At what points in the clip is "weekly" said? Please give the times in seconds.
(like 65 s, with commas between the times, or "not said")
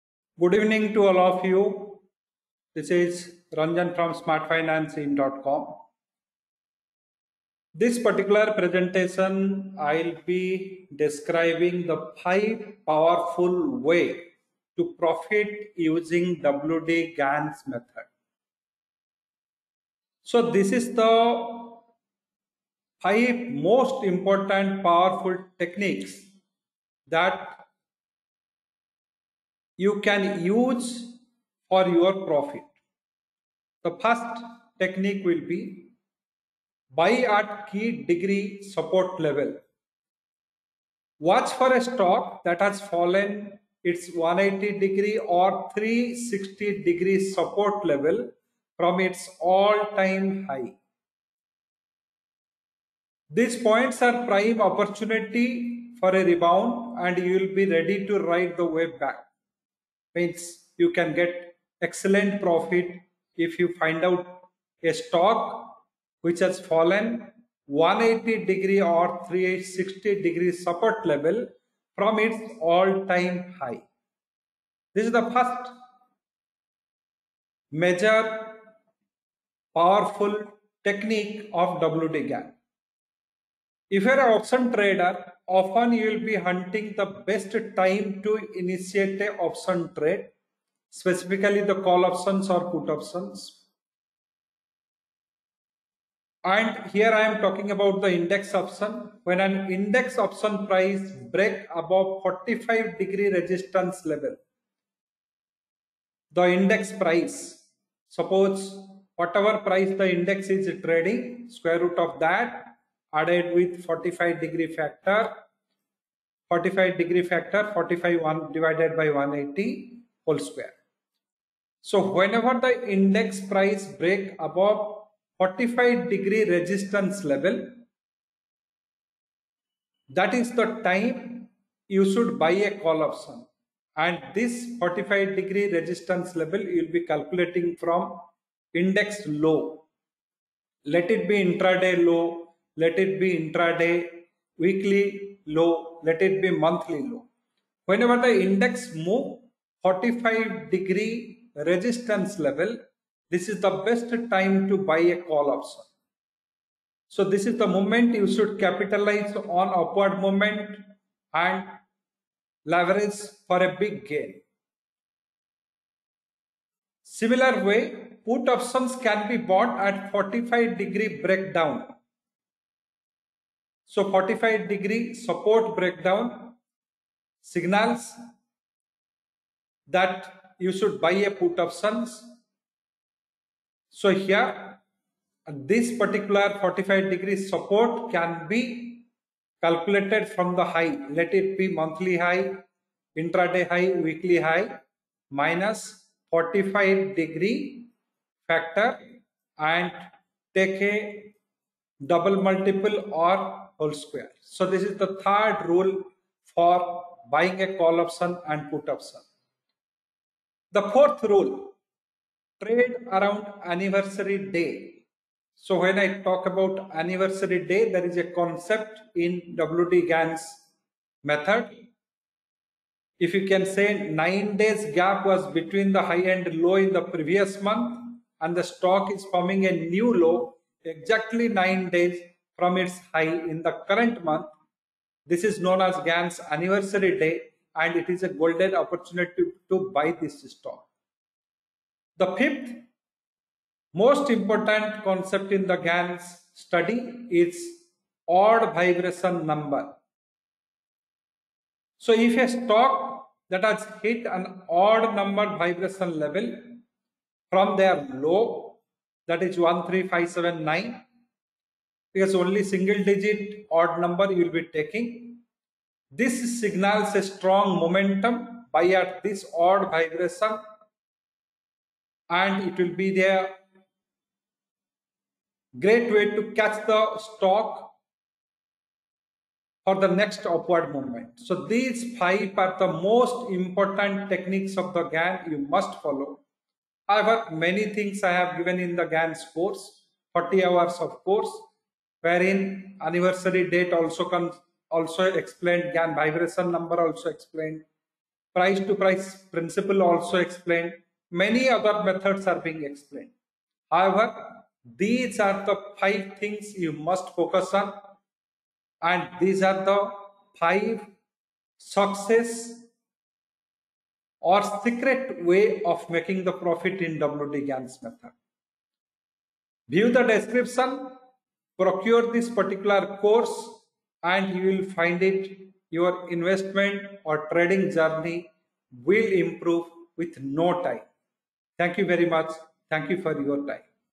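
144 s, 193 s.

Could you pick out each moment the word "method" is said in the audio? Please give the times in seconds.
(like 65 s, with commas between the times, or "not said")
17 s, 221 s, 302 s, 318 s.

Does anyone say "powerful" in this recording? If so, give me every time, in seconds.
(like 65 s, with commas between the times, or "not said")
12 s, 24 s, 79 s.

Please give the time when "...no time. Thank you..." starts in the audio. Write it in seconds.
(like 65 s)
330 s.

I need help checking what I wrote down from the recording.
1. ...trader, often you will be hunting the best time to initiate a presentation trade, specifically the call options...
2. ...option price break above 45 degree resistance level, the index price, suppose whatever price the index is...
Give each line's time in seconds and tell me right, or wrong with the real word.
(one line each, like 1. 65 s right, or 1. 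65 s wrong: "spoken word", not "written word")
1. 84 s wrong: "option", not "presentation"
2. 100 s right.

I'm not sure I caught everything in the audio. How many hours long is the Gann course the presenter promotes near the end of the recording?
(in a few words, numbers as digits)
40 hours.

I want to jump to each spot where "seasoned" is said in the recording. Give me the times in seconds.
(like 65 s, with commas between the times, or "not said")
not said.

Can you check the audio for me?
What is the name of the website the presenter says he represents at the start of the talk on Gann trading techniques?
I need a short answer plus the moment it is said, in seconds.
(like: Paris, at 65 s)
SmartFinancing.com, at 4 s.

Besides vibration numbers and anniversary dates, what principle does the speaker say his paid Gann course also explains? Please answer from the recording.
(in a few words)
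Price to price principle.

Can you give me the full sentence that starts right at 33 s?
The first technique will be buy at key degree support level.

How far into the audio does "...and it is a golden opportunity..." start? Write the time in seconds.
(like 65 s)
237 s.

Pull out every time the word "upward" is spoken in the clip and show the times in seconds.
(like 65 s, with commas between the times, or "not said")
159 s, 280 s.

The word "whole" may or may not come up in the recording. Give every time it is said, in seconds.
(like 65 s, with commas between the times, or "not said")
120 s, 203 s.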